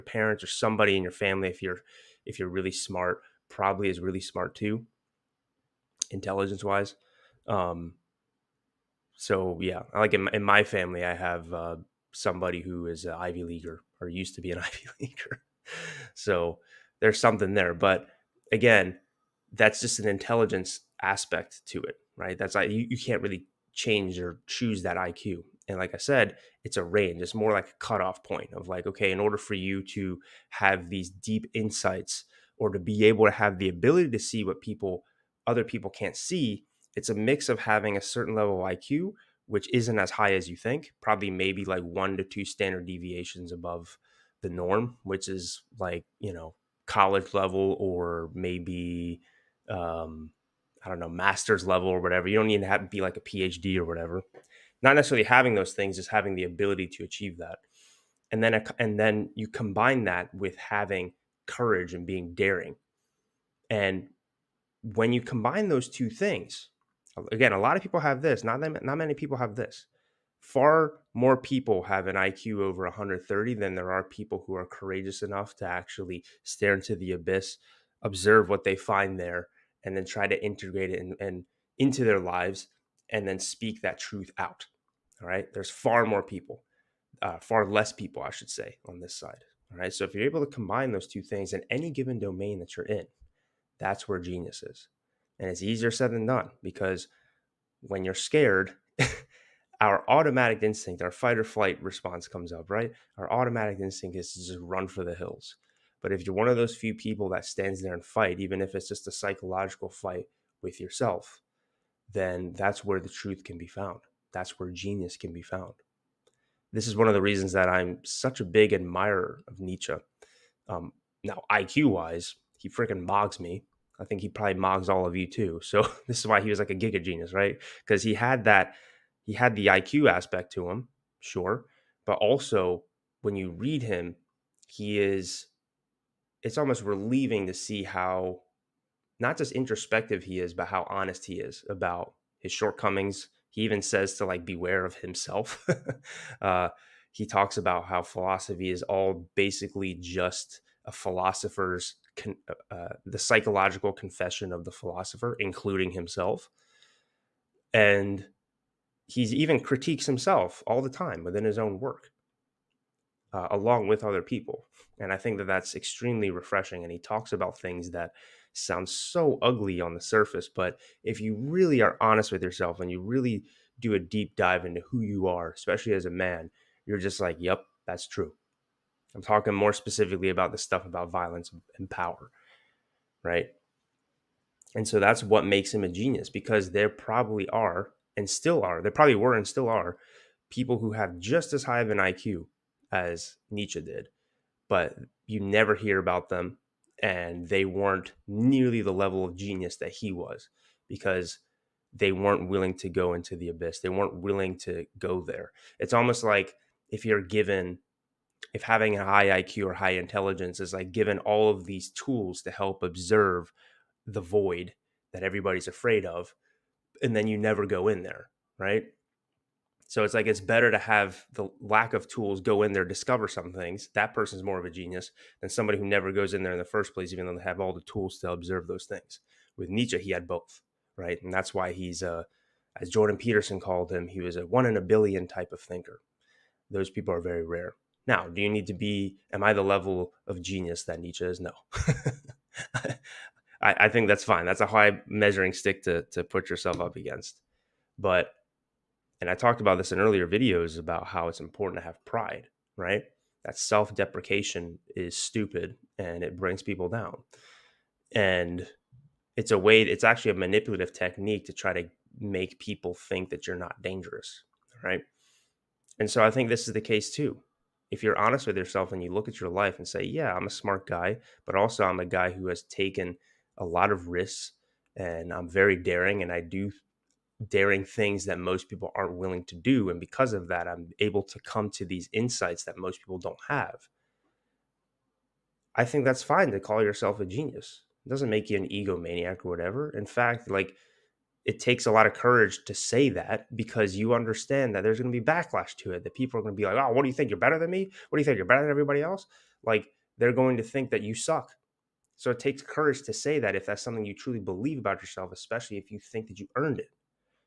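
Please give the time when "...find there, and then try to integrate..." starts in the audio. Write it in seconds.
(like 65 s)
78 s.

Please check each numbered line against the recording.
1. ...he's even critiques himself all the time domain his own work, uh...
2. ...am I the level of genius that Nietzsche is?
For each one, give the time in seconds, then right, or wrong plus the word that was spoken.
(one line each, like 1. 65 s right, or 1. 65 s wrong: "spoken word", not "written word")
1. 159 s wrong: "within", not "domain"
2. 239 s right.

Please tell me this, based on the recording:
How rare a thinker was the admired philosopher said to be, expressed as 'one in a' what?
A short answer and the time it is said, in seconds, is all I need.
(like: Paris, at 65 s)
One in a billion, at 234 s.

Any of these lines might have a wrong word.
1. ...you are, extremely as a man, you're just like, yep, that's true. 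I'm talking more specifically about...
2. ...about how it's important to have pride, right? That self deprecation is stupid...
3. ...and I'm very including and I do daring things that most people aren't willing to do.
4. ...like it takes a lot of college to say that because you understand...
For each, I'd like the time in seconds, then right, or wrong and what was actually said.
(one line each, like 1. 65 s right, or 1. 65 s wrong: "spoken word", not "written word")
1. 175 s wrong: "especially", not "extremely"
2. 250 s right
3. 274 s wrong: "daring", not "including"
4. 290 s wrong: "courage", not "college".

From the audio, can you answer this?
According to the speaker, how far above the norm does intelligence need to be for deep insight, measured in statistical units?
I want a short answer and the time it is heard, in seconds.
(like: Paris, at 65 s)
1 to 2 standard deviations, at 41 s.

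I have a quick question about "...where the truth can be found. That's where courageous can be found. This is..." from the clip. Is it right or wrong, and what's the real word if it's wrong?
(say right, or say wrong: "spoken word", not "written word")
wrong: "genius", not "courageous".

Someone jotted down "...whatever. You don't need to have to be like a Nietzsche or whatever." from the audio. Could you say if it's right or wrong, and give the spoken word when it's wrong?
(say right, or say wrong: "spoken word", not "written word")
wrong: "PhD", not "Nietzsche".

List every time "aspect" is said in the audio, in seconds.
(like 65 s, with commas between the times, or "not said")
21 s, 130 s.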